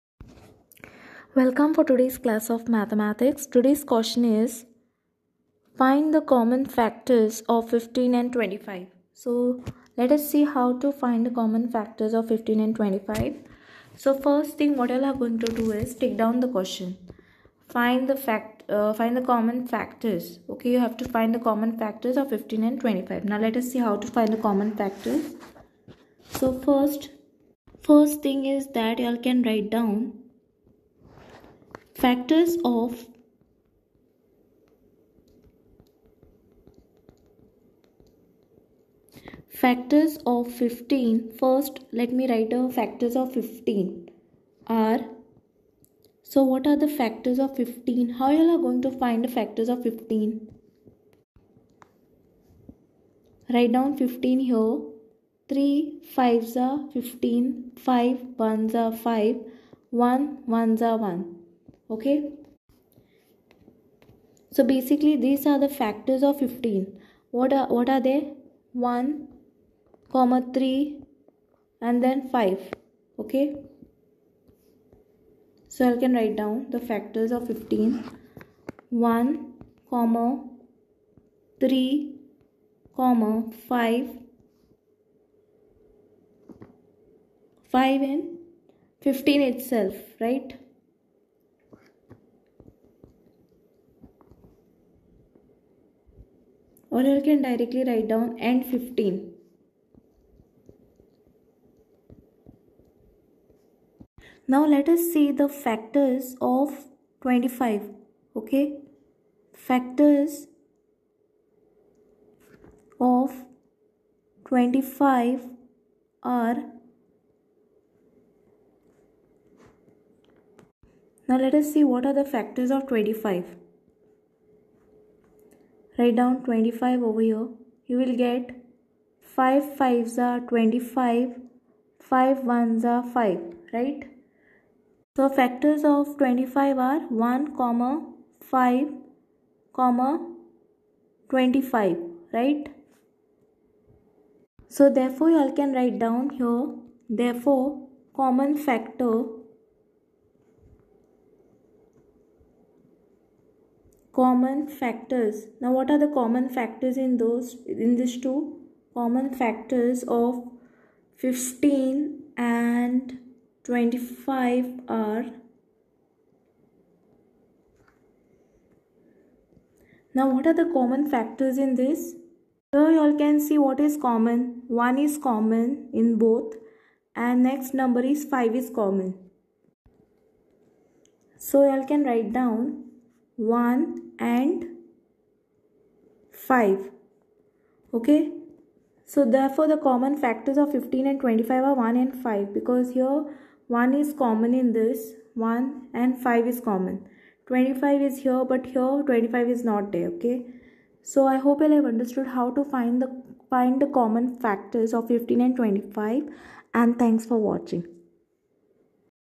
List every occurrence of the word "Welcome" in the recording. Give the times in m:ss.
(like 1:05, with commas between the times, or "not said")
0:01.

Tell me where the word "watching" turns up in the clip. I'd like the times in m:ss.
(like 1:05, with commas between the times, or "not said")
3:27.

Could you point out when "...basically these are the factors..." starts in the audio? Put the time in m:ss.
1:04.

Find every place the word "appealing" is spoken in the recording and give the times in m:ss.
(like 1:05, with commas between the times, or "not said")
not said.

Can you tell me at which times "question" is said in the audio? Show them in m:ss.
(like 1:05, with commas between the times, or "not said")
0:03, 0:16.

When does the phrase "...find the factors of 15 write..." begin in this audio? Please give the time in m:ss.
0:49.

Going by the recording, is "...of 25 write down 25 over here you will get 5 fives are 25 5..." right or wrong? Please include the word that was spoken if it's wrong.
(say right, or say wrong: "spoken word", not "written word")
right.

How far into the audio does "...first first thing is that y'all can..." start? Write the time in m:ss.
0:26.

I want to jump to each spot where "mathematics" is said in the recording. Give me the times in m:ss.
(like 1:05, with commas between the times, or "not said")
0:02.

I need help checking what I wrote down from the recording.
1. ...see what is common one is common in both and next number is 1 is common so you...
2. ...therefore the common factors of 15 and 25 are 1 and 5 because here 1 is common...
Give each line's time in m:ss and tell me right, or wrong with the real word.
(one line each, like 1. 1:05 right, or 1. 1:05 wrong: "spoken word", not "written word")
1. 2:53 wrong: "5", not "1"
2. 3:09 right.